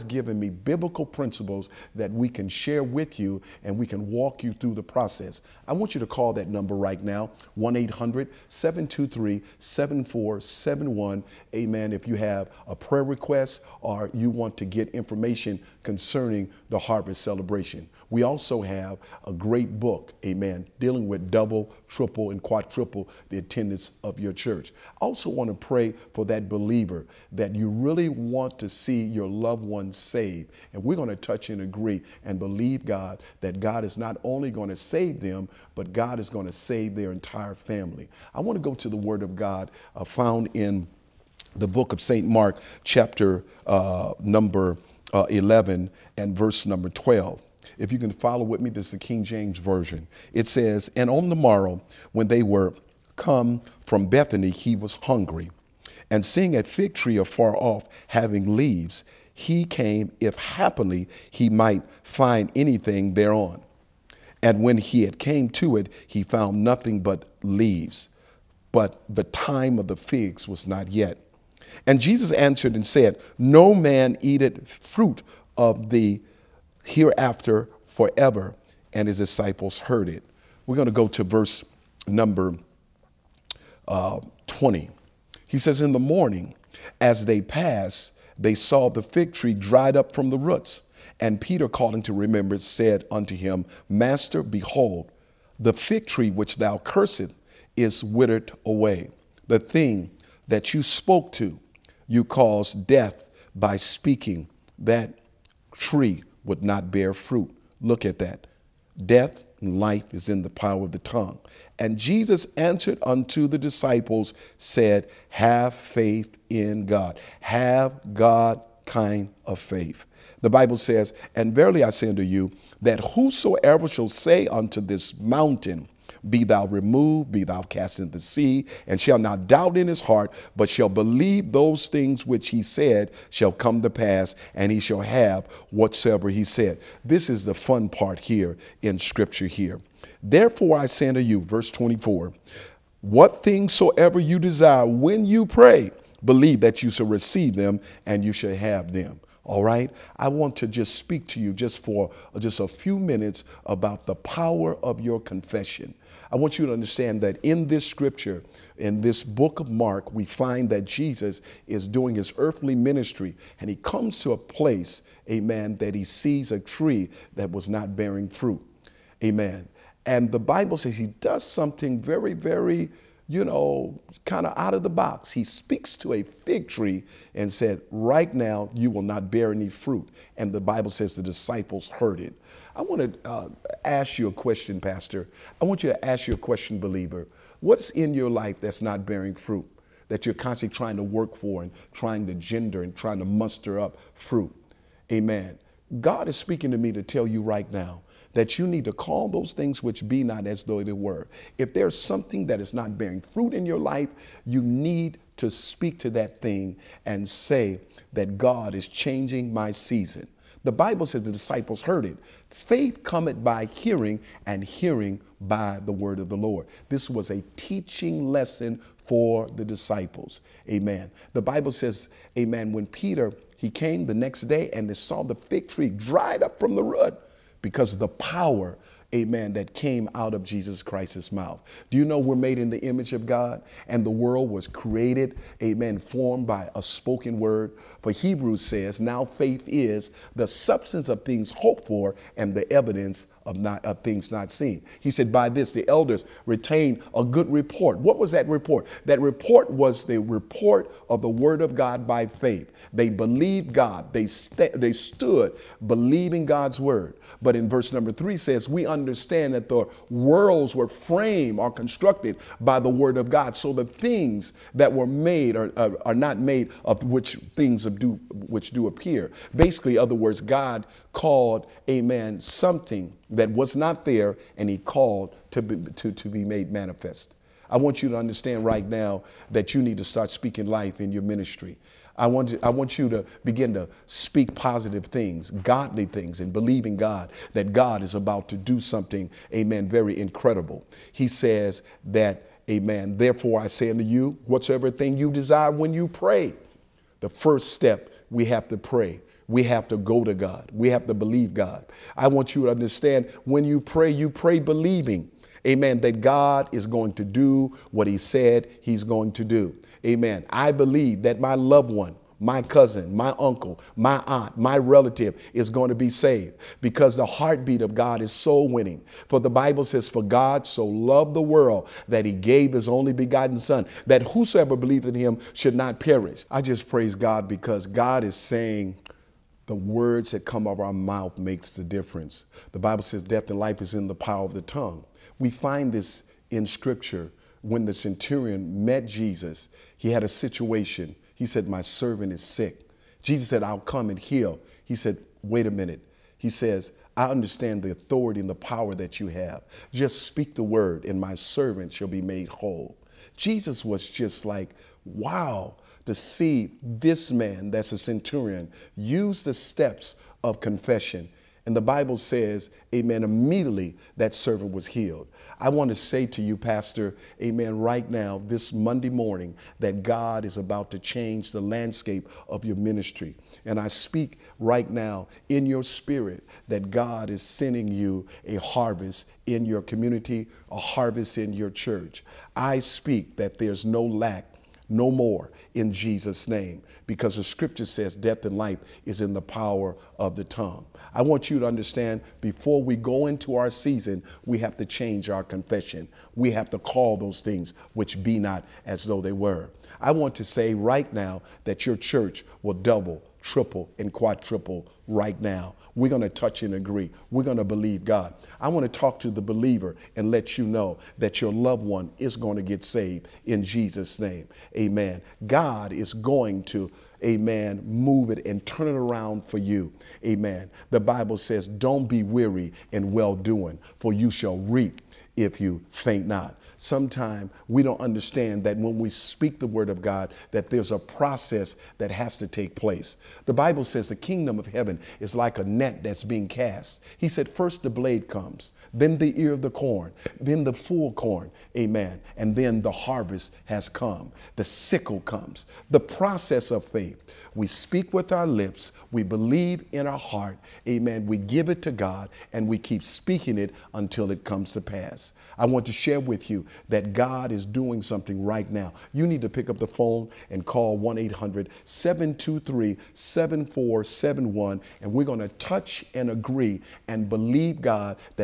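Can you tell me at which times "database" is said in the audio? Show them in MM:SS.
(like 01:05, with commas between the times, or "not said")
not said.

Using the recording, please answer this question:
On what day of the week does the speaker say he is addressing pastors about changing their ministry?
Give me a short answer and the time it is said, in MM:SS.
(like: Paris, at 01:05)
Monday, at 06:08.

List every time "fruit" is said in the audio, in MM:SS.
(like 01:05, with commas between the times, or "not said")
01:14, 01:47, 02:48, 02:59, 03:09, 03:14, 03:23.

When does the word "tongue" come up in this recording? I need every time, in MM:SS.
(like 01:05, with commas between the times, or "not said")
01:51, 05:34, 06:30.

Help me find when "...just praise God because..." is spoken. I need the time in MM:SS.
05:26.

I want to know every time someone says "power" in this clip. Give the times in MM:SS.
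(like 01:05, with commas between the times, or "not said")
01:50, 02:34, 03:48, 05:34, 05:48, 06:29.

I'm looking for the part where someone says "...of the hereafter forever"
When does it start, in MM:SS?
01:15.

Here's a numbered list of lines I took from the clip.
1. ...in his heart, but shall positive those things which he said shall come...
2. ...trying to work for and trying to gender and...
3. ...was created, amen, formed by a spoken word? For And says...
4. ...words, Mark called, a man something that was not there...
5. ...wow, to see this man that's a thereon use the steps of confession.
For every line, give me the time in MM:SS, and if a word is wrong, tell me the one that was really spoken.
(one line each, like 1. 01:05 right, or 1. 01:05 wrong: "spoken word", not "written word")
1. 02:09 wrong: "believe", not "positive"
2. 03:10 right
3. 03:54 wrong: "Hebrews", not "And"
4. 04:30 wrong: "God", not "Mark"
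5. 05:55 wrong: "centurion", not "thereon".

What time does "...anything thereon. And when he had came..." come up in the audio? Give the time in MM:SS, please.
01:02.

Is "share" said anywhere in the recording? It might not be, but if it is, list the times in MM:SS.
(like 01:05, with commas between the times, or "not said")
00:02, 07:35.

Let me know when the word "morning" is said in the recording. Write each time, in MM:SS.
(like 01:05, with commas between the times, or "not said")
01:25, 06:09.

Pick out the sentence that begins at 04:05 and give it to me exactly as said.
He said, By this the elders retain a good report.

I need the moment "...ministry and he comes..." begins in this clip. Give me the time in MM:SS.
02:42.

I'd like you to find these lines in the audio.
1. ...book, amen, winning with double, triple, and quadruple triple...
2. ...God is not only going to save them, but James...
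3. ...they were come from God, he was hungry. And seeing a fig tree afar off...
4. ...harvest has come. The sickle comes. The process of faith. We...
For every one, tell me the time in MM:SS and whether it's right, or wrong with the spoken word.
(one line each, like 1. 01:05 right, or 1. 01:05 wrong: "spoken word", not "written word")
1. 00:19 wrong: "dealing", not "winning"
2. 00:33 wrong: "God", not "James"
3. 00:52 wrong: "Bethany", not "God"
4. 07:22 right.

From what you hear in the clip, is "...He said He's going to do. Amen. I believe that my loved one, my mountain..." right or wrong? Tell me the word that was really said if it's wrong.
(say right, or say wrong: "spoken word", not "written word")
wrong: "cousin", not "mountain".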